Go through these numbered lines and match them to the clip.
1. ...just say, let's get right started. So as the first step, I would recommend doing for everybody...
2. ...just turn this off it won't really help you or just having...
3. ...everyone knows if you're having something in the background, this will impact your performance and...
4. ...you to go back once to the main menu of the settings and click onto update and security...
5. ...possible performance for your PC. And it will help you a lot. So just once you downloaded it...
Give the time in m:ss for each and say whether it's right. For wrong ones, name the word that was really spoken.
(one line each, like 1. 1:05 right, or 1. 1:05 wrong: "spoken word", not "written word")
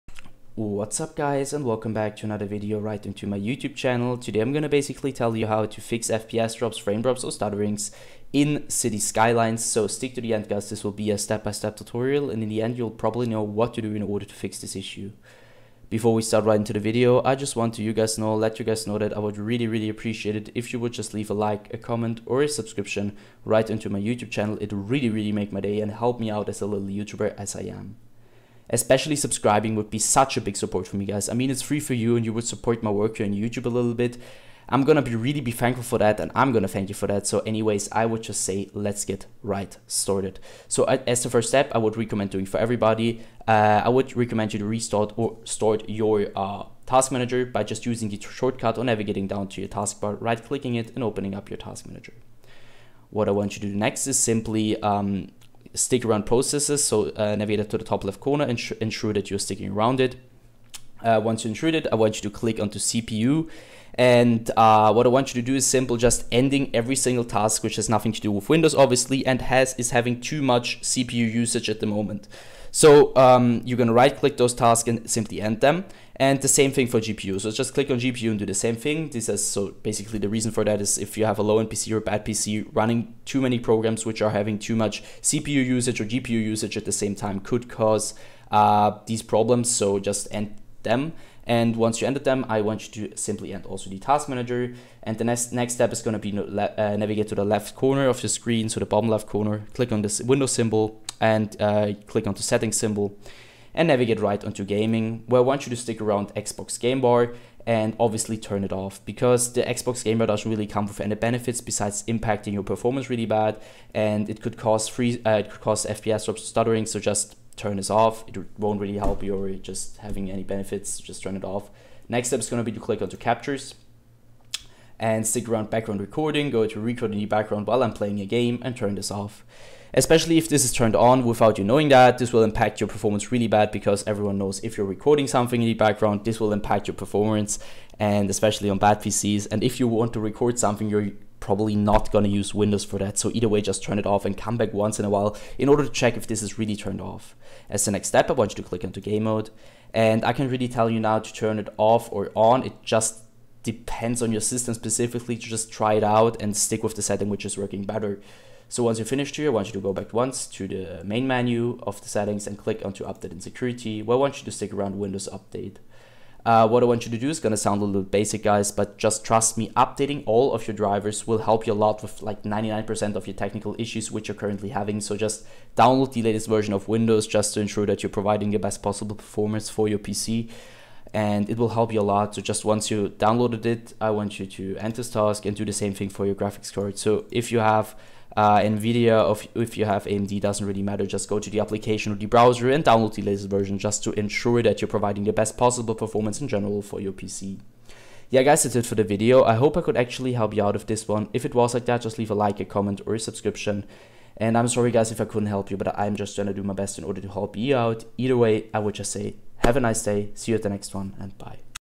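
1. 0:38 right
2. 1:56 right
3. 2:14 wrong: "recording", not "having"
4. 2:39 right
5. 2:58 right.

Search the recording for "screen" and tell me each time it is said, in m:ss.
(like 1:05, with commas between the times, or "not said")
1:38.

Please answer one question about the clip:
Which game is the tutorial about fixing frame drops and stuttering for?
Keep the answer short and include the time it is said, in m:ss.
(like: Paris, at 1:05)
City Skylines, at 0:08.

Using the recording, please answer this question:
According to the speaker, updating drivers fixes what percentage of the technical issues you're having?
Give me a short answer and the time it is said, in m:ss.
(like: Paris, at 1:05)
99%, at 2:52.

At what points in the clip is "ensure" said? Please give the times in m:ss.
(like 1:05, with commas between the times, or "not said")
0:58, 2:57, 3:14.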